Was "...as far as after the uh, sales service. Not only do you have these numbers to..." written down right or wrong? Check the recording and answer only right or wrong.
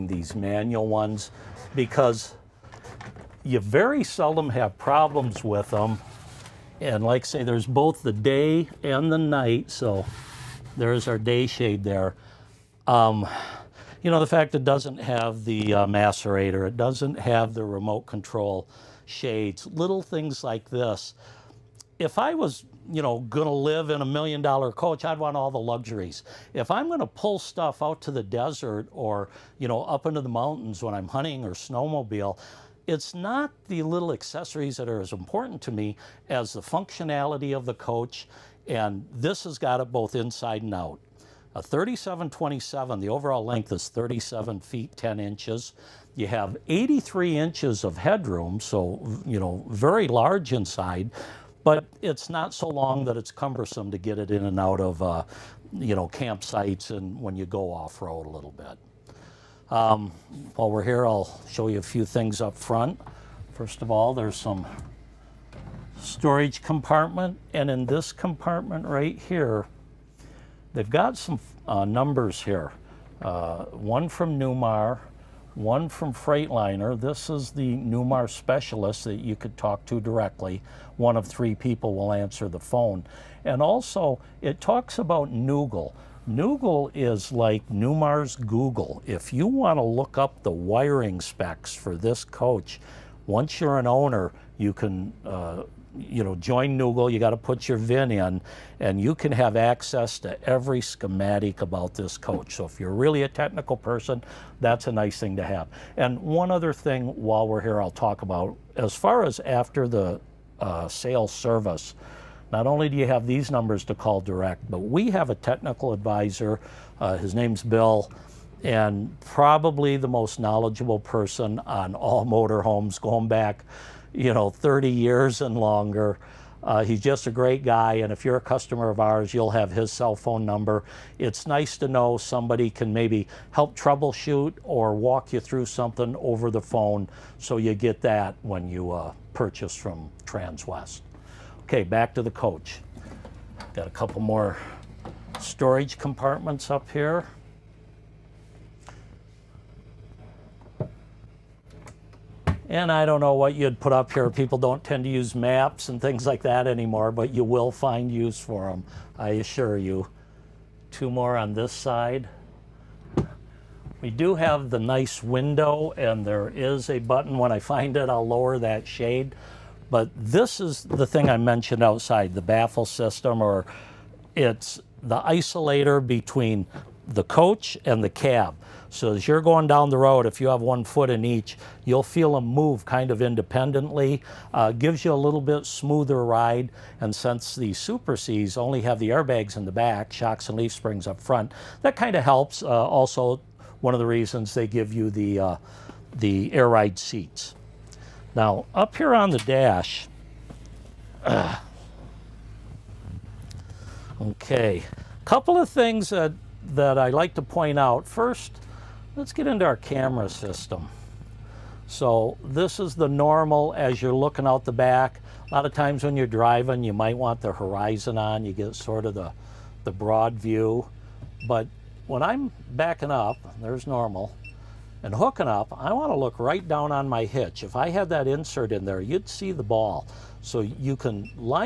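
right.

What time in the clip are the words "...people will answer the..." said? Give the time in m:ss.
1:21.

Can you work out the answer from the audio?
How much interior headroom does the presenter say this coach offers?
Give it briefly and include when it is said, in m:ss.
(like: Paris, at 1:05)
83 inches, at 0:46.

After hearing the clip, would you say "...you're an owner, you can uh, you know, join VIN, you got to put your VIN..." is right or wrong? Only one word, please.
wrong.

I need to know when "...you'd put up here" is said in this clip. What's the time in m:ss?
2:33.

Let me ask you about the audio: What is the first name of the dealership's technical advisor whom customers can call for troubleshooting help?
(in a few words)
Bill.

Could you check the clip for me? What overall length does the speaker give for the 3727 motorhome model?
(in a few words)
37 feet 10 inches.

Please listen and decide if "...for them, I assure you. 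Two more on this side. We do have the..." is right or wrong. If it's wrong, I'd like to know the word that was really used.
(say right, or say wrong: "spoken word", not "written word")
right.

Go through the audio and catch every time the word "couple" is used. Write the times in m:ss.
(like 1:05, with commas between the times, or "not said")
2:23, 3:25.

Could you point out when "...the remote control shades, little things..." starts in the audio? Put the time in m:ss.
0:17.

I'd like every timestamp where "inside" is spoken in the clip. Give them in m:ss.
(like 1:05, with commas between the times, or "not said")
0:40, 0:50.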